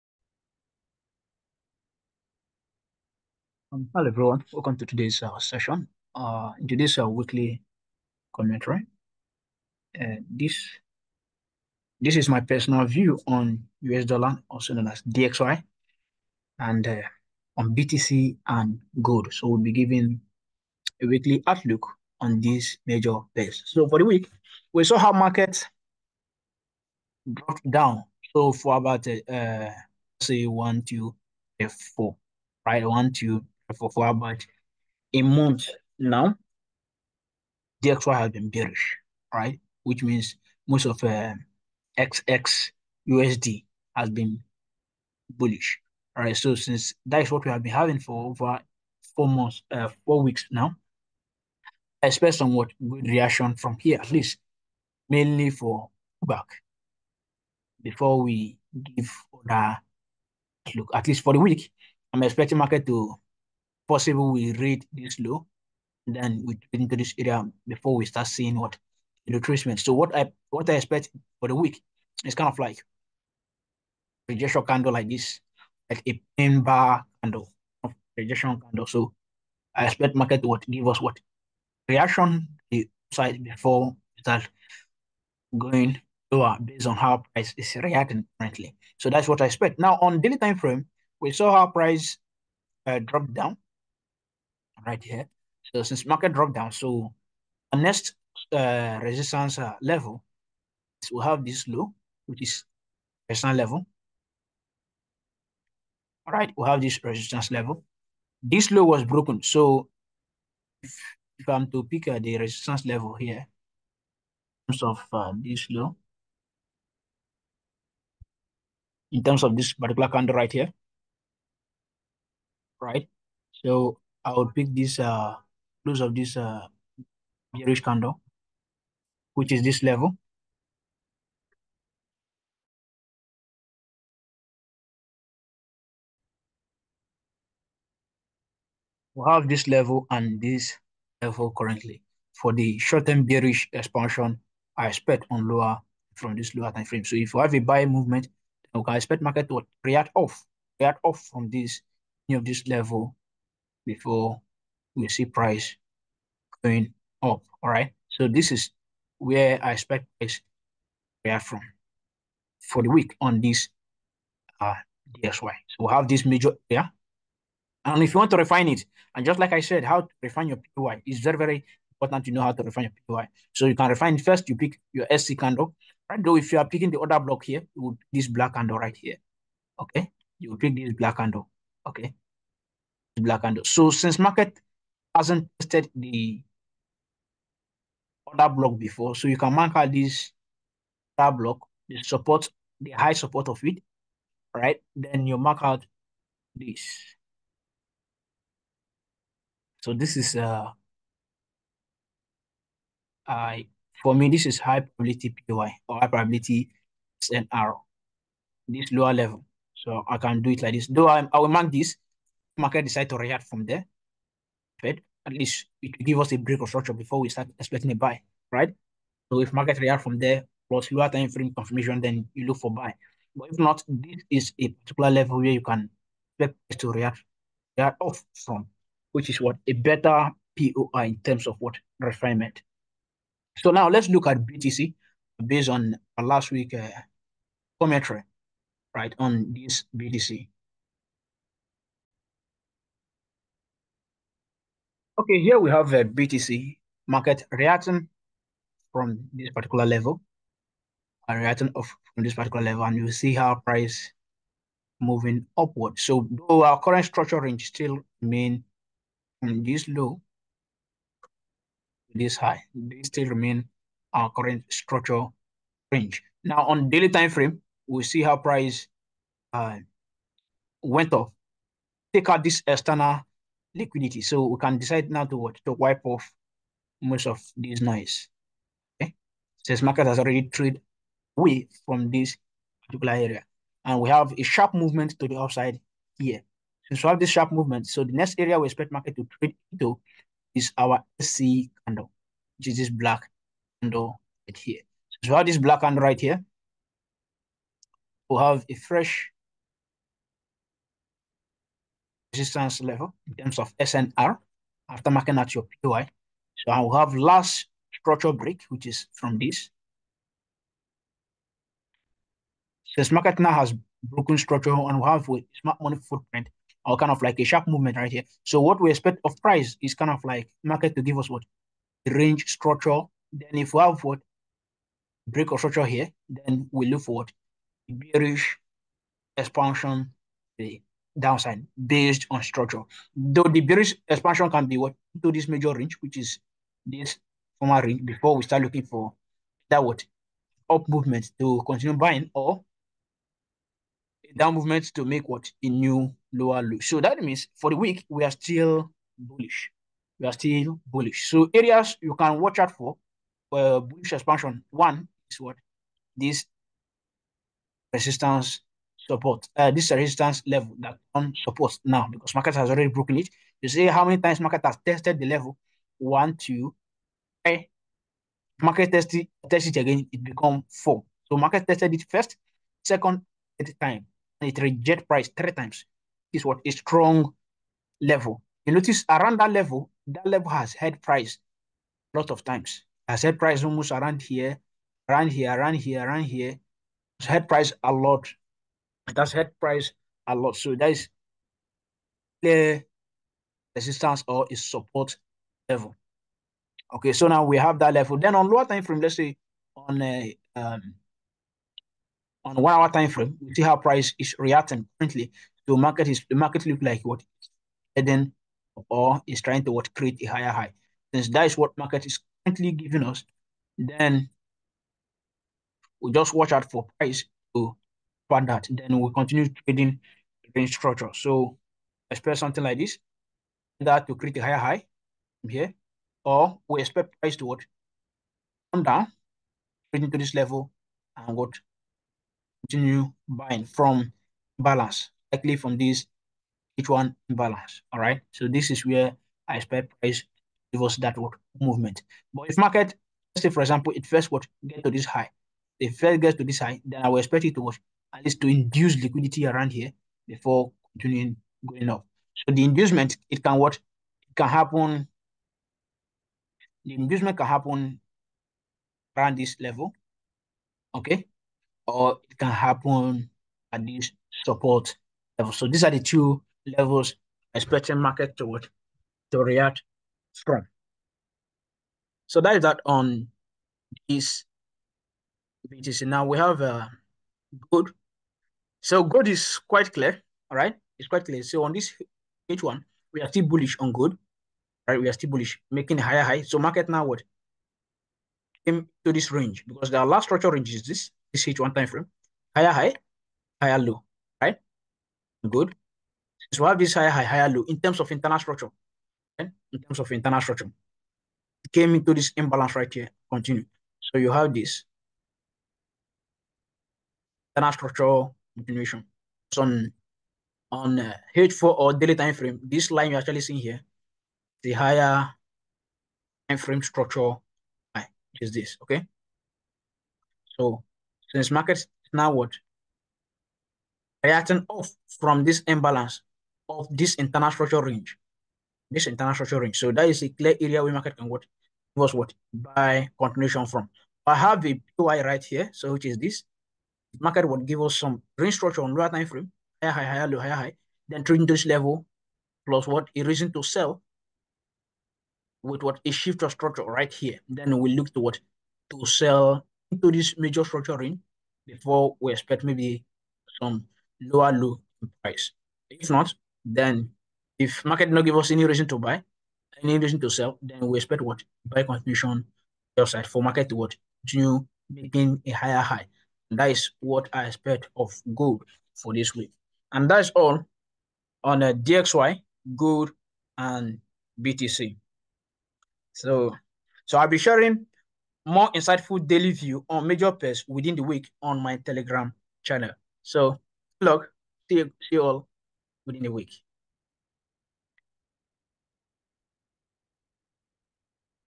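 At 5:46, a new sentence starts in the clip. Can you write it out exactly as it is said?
So that means for the week we are still bullish.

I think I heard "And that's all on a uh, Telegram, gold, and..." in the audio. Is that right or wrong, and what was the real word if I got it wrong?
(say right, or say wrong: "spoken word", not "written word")
wrong: "DXY", not "Telegram".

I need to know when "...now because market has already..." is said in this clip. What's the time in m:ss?
6:01.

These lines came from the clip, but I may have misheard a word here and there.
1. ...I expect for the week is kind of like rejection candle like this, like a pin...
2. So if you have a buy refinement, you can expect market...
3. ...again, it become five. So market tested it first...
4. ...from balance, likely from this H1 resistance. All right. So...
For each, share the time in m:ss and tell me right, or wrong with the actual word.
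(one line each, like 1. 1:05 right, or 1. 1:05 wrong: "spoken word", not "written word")
1. 1:10 right
2. 2:27 wrong: "movement", not "refinement"
3. 6:09 wrong: "four", not "five"
4. 7:13 wrong: "balance", not "resistance".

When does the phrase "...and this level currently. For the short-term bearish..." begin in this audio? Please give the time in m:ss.
2:20.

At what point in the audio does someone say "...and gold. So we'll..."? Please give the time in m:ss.
0:18.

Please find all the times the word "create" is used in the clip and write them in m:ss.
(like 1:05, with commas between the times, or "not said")
6:49, 7:04.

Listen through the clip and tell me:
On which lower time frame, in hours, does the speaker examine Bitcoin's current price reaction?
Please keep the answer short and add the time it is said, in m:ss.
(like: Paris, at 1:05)
one hour, at 6:42.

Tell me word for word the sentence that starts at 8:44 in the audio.
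Reacting off from this imbalance of this internal structure range, this internal structure range.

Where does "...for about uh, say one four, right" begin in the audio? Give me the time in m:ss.
0:28.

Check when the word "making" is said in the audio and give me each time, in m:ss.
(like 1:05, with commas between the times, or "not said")
8:05, 9:24.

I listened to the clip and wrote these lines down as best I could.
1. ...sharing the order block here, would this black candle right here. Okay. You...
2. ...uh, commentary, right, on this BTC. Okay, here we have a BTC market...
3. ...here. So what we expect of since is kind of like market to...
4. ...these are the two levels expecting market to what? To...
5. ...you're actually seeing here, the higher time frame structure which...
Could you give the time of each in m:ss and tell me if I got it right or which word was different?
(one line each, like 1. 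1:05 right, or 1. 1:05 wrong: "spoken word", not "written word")
1. 2:56 wrong: "picking", not "sharing"
2. 3:56 right
3. 5:18 wrong: "price", not "since"
4. 7:45 right
5. 8:33 right.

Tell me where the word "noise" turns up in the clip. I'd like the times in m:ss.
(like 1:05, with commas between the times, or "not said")
4:37.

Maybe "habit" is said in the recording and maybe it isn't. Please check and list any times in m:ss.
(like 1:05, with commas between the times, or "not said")
not said.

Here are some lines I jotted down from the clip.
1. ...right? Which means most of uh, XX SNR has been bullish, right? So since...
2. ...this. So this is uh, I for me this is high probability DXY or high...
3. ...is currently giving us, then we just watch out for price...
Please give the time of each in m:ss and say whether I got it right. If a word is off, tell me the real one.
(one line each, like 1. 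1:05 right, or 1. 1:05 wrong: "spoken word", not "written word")
1. 0:39 wrong: "USD", not "SNR"
2. 3:16 wrong: "POI", not "DXY"
3. 6:52 right.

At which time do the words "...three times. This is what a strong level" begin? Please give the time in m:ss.
6:15.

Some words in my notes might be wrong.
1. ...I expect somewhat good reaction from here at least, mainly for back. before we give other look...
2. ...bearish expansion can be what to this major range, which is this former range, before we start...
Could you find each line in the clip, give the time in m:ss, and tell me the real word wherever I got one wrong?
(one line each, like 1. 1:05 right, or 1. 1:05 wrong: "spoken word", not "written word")
1. 0:52 right
2. 5:33 right.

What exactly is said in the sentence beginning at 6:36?
Okay, so now we have that level.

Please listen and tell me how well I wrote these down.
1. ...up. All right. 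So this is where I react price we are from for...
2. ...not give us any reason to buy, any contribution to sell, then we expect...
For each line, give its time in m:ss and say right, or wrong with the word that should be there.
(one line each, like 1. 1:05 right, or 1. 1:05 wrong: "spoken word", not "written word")
1. 2:37 wrong: "expect", not "react"
2. 9:18 wrong: "reason", not "contribution".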